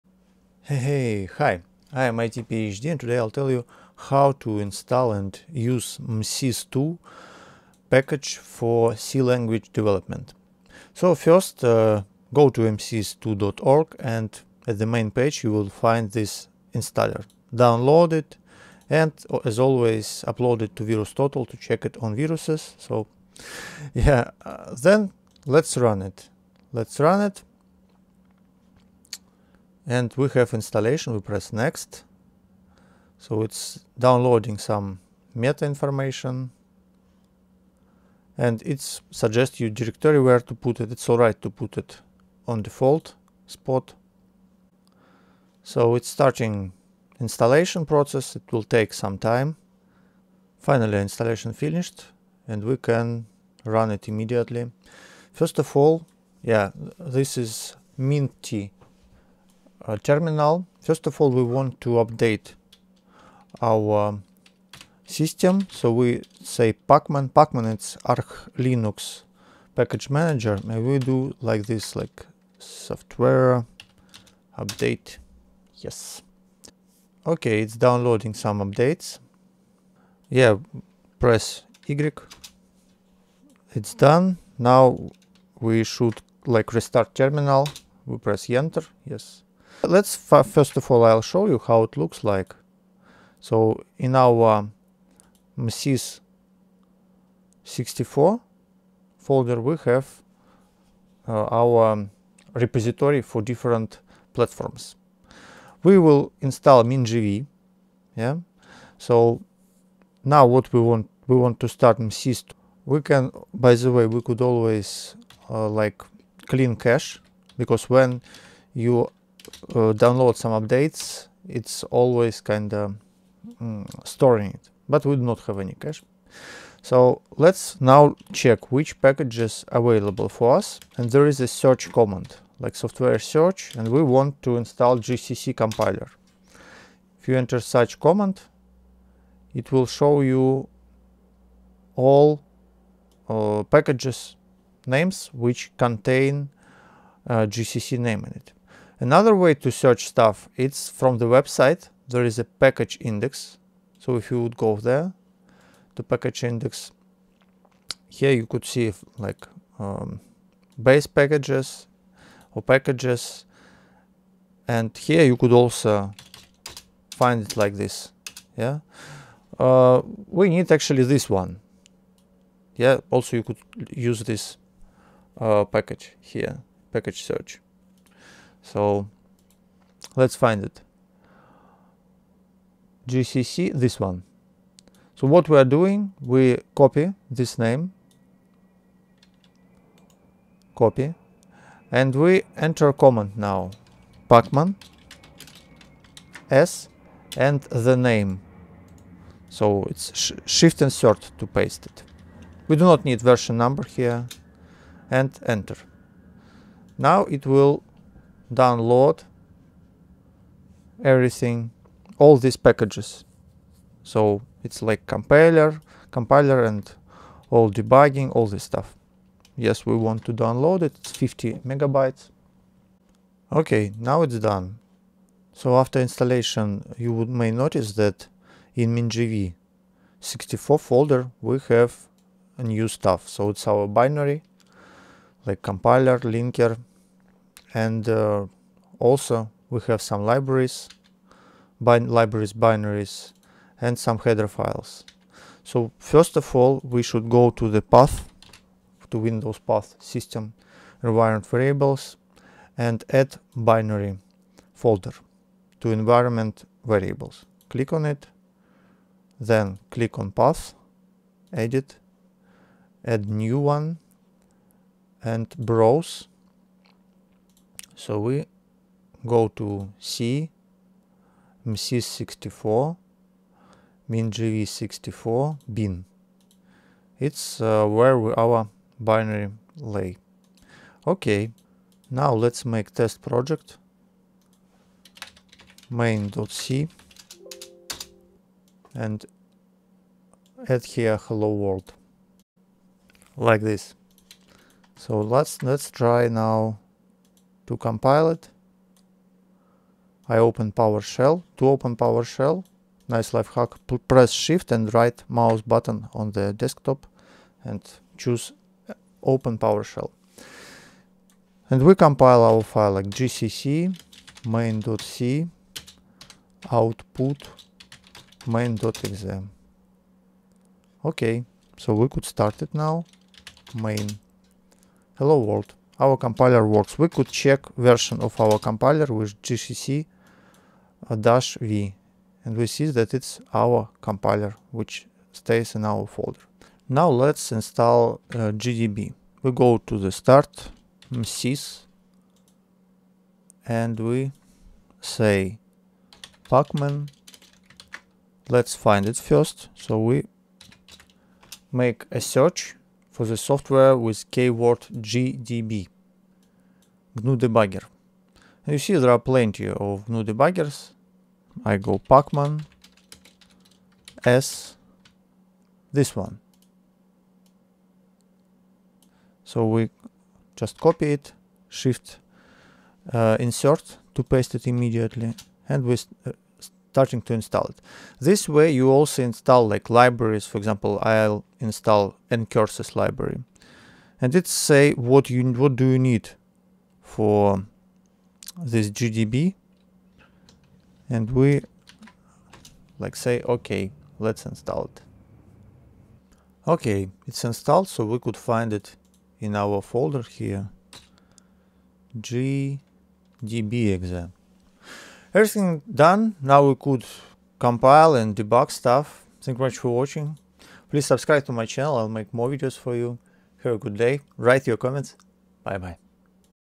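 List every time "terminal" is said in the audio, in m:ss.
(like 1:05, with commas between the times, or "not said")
0:59, 1:27.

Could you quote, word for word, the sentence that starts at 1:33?
So in our MSYS um, 64 folder we have uh, our um, repository for different platforms.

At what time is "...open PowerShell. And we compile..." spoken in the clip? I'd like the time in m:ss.
5:09.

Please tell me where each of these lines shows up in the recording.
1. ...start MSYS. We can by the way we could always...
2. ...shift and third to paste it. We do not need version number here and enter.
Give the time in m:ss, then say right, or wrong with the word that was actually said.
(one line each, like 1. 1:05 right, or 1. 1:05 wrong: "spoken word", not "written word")
1. 1:51 right
2. 3:20 right.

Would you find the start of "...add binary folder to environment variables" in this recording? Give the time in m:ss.
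4:13.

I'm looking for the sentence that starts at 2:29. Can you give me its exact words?
Another way to search stuff, it's from the website.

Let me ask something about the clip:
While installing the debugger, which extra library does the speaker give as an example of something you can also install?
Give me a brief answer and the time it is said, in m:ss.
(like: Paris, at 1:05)
ncurses, at 6:22.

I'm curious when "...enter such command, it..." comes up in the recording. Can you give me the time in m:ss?
2:17.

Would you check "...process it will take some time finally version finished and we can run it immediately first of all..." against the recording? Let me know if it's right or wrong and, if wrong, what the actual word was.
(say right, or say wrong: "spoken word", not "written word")
wrong: "installation", not "version".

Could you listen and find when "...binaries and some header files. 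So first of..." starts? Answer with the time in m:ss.
4:02.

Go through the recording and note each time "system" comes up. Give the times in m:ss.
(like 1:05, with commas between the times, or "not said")
1:05, 4:09.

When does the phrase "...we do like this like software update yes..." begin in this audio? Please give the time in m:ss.
1:10.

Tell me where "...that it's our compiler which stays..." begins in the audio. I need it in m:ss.
5:32.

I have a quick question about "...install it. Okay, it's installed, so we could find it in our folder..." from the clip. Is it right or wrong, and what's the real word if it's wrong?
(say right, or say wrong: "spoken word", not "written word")
right.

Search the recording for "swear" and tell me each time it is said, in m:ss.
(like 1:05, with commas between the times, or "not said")
not said.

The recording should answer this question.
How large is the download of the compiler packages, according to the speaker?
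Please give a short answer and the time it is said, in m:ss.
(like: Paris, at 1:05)
50 megabytes, at 3:41.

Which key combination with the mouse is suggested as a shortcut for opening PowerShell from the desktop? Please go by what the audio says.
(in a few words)
Shift and right mouse button.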